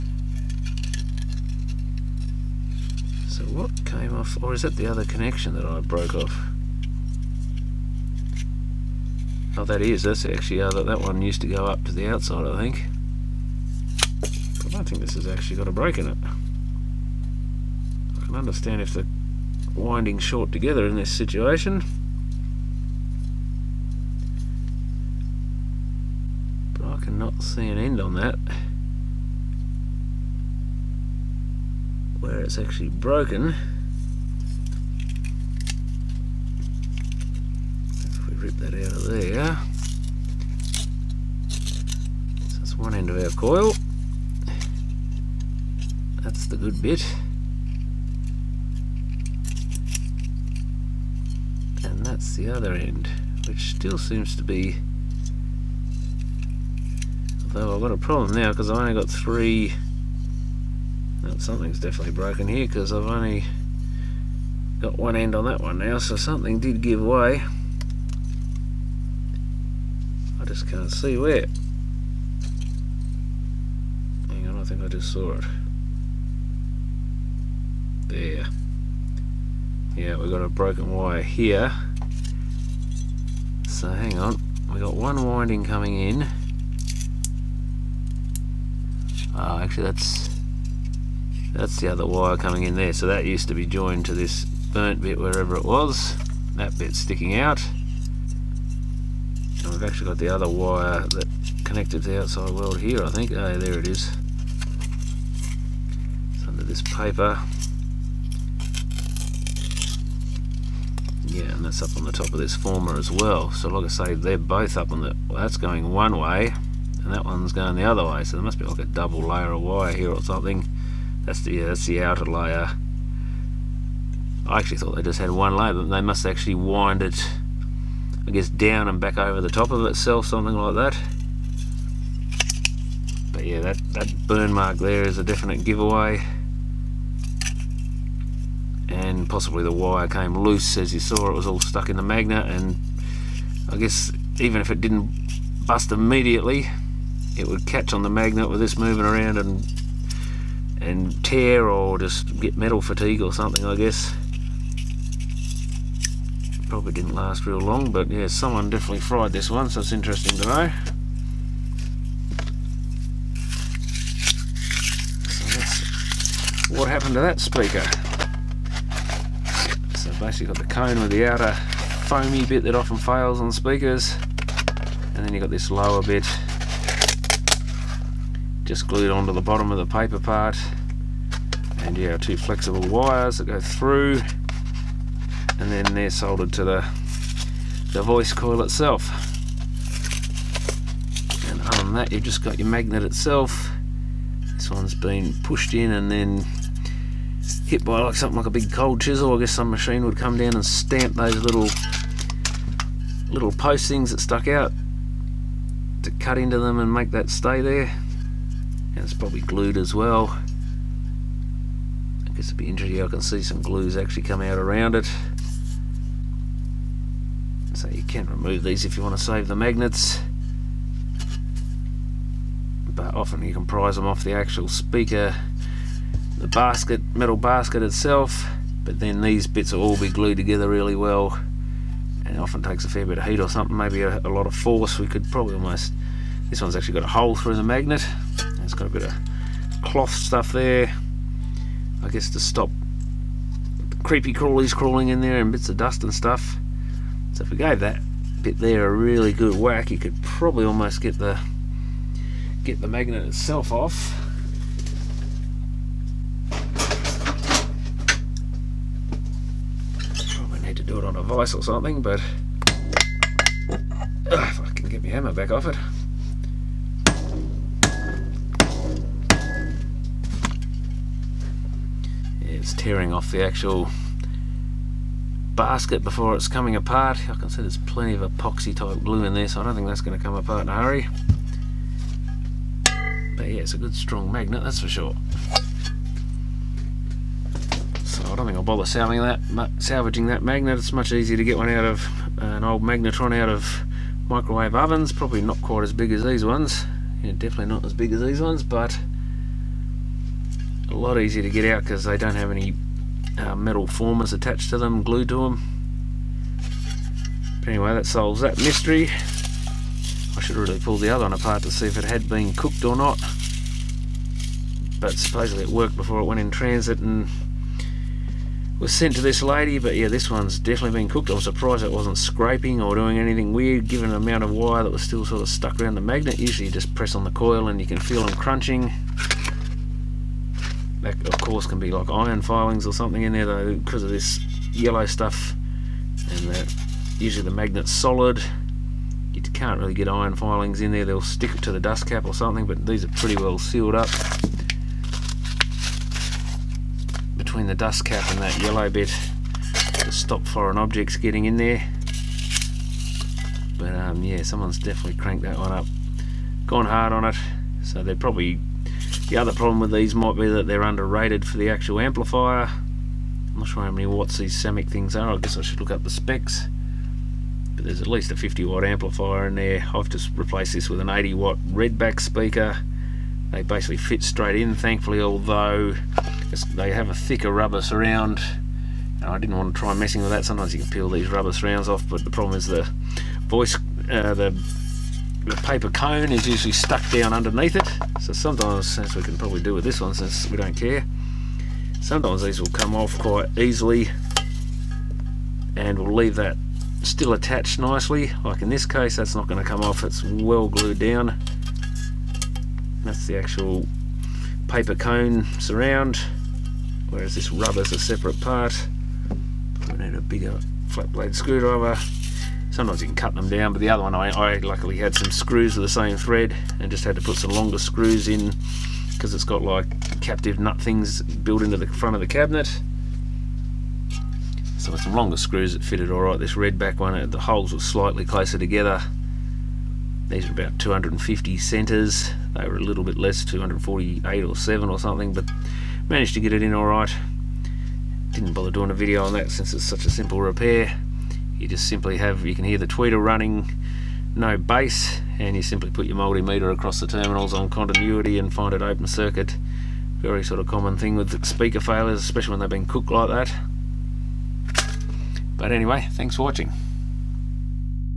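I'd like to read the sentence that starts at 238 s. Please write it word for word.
It's got a bit of cloth stuff there.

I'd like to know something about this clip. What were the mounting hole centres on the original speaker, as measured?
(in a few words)
250.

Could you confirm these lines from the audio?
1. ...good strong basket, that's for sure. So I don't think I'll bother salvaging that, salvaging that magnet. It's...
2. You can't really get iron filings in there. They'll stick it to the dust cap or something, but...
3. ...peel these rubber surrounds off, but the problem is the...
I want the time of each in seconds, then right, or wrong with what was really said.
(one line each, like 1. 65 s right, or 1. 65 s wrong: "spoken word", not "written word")
1. 283 s wrong: "magnet", not "basket"
2. 339 s right
3. 380 s right.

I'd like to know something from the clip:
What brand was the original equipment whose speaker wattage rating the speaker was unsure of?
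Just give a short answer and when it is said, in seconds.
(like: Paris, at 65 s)
Samick, at 364 s.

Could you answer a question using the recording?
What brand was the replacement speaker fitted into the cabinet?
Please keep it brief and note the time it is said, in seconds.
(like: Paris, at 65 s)
Redback, at 371 s.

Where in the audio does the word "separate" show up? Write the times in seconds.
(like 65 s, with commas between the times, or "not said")
407 s.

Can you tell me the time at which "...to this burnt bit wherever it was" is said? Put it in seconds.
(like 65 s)
94 s.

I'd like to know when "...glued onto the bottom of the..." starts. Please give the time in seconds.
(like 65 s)
178 s.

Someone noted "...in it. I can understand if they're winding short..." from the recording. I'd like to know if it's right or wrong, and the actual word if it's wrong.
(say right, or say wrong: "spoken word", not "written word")
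right.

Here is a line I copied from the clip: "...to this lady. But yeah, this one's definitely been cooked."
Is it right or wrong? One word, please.
right.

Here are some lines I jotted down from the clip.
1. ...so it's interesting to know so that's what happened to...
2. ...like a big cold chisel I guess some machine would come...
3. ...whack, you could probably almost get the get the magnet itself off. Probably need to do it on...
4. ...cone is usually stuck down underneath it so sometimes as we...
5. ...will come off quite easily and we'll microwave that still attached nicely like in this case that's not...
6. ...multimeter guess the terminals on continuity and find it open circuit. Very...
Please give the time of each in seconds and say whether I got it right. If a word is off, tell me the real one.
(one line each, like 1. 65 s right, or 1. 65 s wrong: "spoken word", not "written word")
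1. 159 s right
2. 198 s right
3. 249 s right
4. 385 s right
5. 392 s wrong: "leave", not "microwave"
6. 446 s wrong: "across", not "guess".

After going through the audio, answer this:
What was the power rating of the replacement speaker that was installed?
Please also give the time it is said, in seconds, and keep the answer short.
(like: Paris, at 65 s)
80 watt, at 371 s.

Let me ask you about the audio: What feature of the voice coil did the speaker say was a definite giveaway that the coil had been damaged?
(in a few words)
burn mark.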